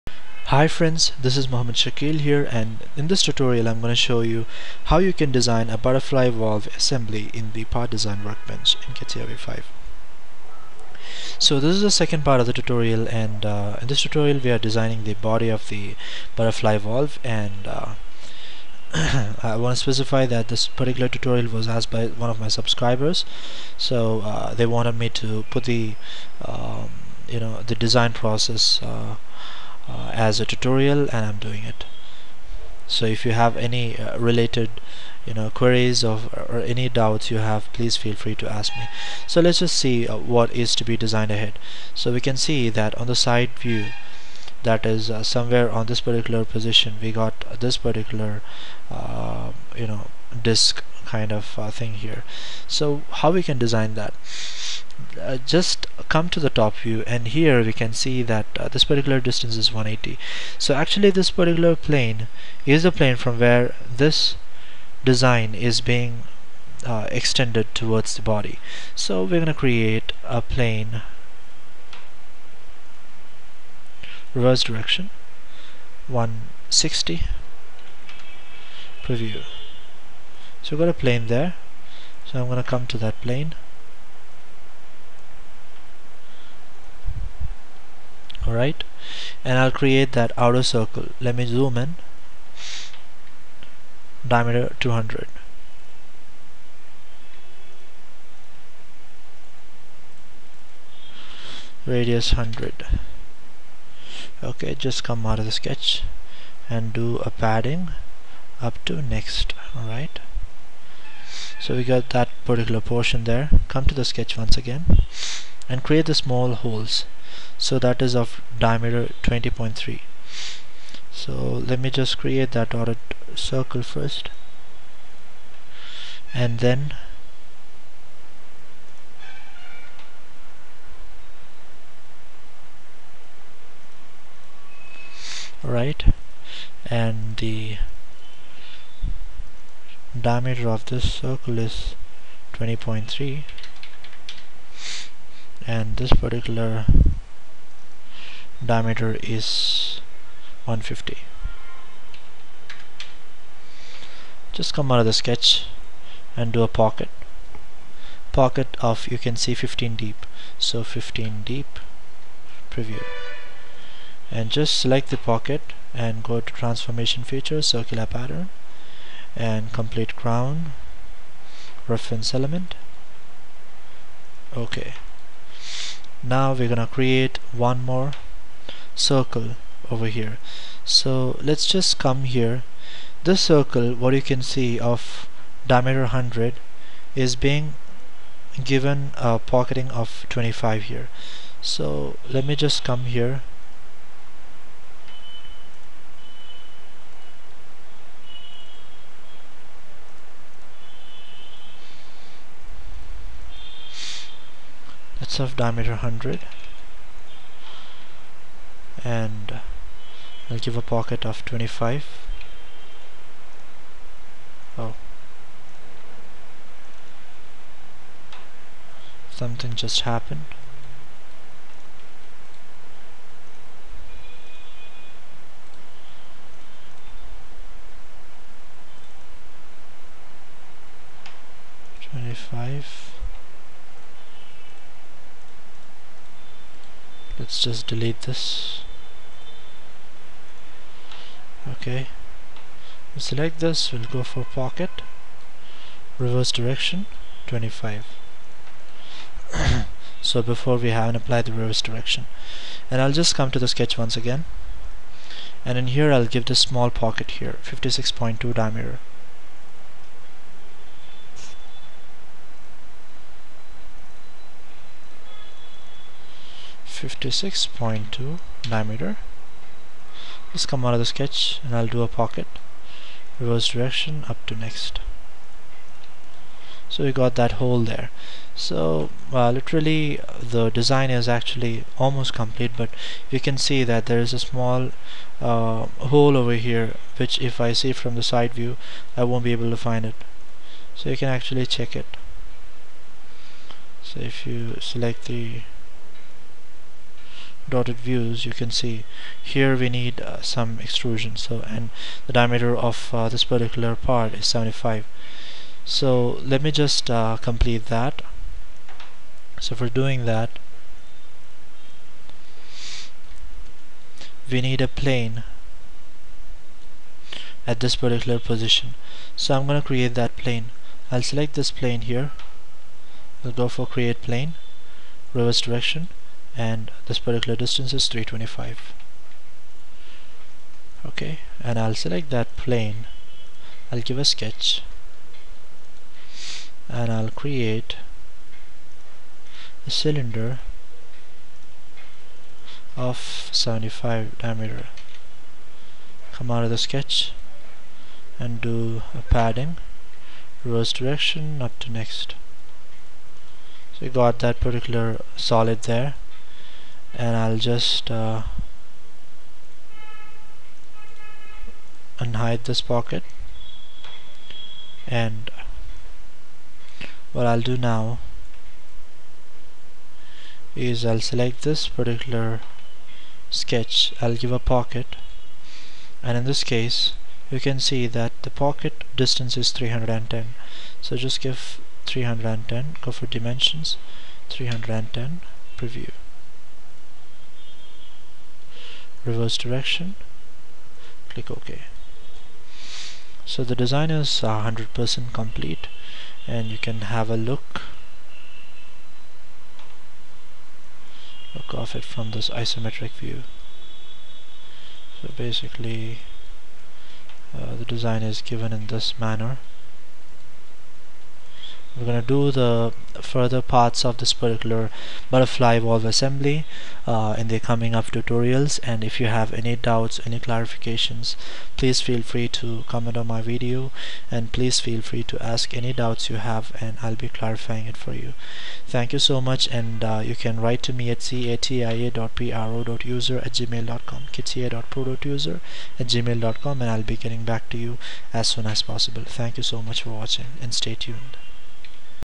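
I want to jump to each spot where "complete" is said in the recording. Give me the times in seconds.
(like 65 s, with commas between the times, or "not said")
169 s, 282 s, 307 s, 395 s.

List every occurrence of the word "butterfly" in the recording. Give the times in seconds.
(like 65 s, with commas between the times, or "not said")
5 s, 16 s, 415 s.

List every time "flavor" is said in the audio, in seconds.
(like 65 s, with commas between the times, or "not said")
not said.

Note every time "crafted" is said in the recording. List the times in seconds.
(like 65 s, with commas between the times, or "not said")
not said.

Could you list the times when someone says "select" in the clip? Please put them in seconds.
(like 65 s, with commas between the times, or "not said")
164 s, 243 s, 294 s, 321 s, 331 s, 371 s.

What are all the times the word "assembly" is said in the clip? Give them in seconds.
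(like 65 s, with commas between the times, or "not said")
6 s, 416 s.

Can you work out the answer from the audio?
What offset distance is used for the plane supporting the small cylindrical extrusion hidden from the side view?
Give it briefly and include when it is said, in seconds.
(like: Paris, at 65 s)
325, at 328 s.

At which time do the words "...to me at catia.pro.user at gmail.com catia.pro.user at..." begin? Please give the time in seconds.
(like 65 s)
430 s.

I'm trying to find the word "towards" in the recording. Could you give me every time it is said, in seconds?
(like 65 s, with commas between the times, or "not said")
67 s.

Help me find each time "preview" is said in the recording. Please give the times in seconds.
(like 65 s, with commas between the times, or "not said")
79 s, 162 s, 385 s.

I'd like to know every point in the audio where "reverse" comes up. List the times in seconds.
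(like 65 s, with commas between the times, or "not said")
74 s, 246 s, 251 s, 273 s, 325 s, 350 s, 389 s.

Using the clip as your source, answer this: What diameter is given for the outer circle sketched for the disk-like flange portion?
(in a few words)
200.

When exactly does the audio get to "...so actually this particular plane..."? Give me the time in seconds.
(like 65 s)
60 s.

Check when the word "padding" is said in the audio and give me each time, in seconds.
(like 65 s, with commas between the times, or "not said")
107 s, 349 s.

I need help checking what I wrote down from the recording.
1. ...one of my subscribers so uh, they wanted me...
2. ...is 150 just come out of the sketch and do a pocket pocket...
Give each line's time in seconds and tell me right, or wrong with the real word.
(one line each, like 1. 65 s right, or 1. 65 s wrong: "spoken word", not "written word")
1. 22 s right
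2. 149 s right.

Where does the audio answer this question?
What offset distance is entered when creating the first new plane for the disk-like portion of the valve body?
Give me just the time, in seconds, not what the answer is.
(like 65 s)
76 s.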